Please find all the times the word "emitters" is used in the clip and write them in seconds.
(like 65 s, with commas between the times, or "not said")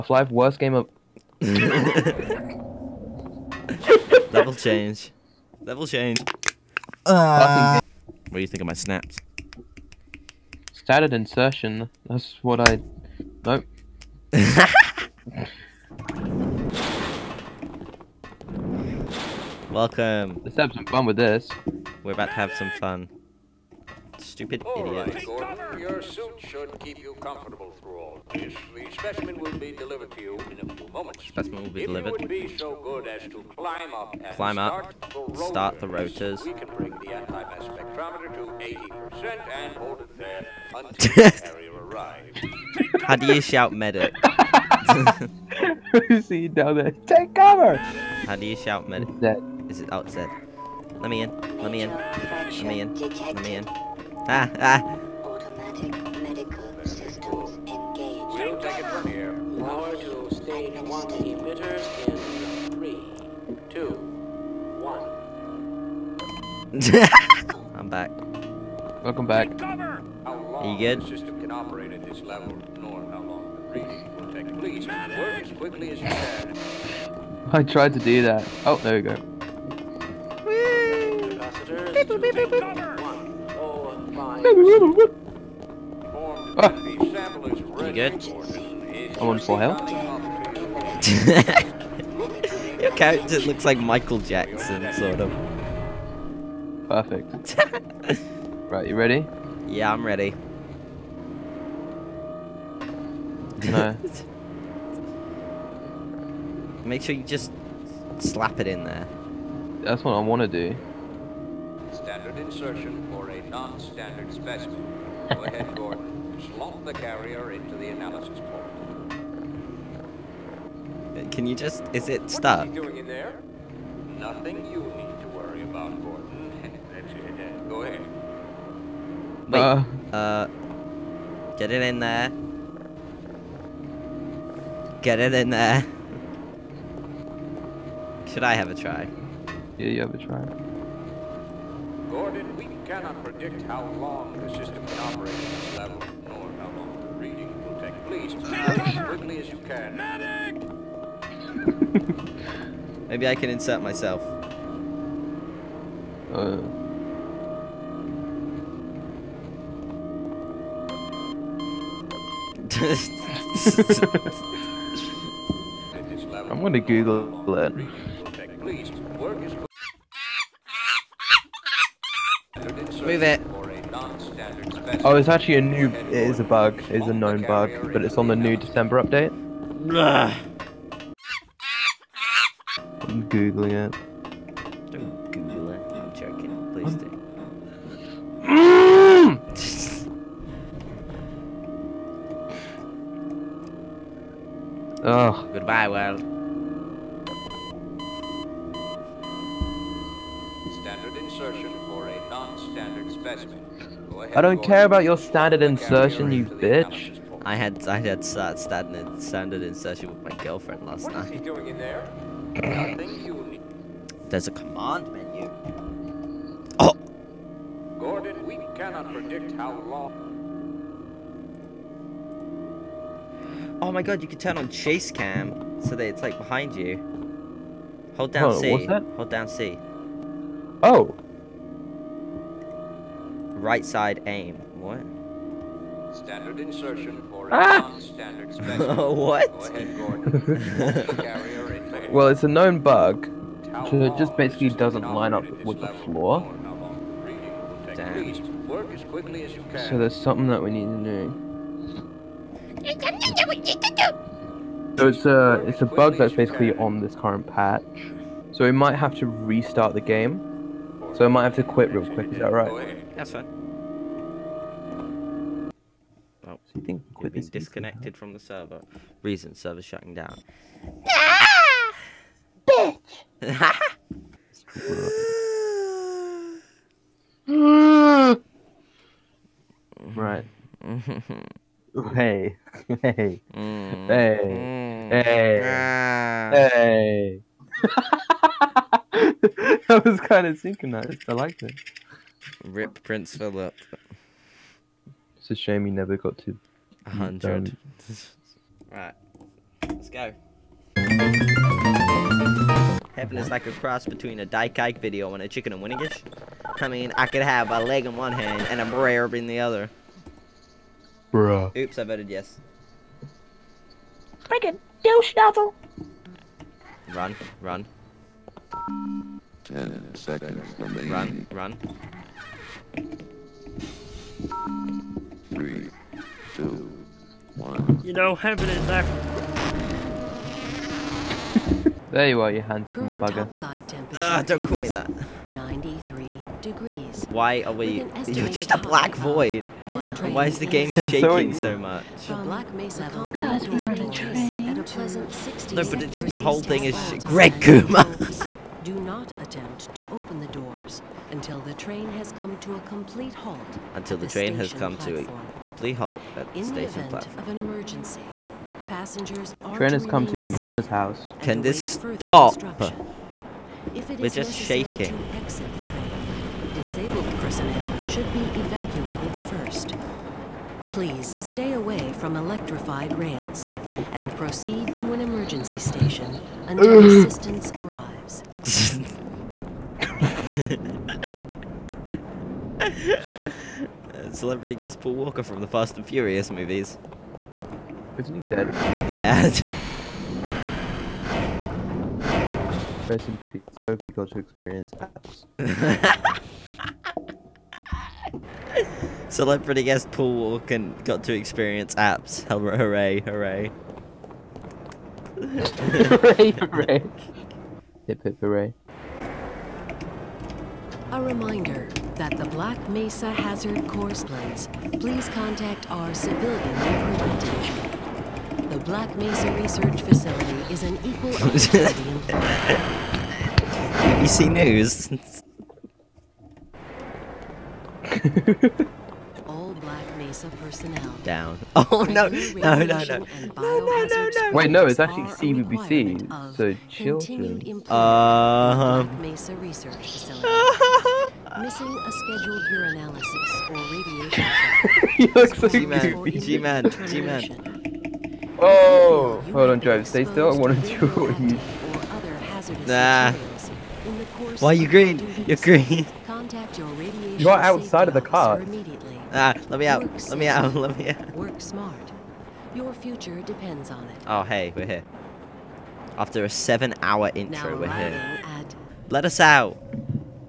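61 s.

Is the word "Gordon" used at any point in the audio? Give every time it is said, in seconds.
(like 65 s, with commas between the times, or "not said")
25 s, 115 s, 126 s, 142 s, 217 s.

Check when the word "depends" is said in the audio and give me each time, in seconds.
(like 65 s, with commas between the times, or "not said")
463 s.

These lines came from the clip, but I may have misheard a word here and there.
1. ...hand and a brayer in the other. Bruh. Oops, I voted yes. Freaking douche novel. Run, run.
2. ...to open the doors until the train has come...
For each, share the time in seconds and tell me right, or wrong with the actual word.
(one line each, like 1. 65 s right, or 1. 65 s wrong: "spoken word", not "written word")
1. 308 s right
2. 349 s right.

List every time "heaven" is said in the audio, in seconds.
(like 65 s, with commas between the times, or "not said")
303 s, 328 s.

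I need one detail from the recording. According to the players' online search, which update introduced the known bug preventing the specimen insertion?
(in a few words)
December update.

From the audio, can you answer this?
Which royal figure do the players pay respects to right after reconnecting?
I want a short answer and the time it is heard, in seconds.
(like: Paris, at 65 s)
Prince Philip, at 293 s.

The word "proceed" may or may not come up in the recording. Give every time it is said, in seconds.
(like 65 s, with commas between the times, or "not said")
374 s.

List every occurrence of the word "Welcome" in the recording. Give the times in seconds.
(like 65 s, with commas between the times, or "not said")
19 s, 69 s.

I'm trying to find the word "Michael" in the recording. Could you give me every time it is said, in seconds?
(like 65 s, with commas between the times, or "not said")
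93 s.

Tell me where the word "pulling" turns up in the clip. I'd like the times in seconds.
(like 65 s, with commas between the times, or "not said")
not said.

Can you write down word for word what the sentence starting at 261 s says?
So I might have to quit real quick, is that right?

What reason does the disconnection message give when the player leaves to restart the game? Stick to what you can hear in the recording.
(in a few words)
Server shutting down.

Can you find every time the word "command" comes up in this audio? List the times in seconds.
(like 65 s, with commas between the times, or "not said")
214 s.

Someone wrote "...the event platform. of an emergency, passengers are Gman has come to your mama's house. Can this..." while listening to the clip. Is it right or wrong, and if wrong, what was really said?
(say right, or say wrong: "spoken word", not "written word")
wrong: "Train", not "Gman".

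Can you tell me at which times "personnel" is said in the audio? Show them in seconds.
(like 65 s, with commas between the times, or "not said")
367 s, 430 s.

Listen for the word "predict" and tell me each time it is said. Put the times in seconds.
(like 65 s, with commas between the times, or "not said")
143 s, 219 s.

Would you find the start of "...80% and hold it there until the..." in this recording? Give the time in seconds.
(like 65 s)
39 s.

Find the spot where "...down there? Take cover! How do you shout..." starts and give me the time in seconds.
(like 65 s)
46 s.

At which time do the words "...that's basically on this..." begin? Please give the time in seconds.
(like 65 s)
256 s.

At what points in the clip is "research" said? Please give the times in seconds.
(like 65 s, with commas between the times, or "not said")
419 s, 439 s.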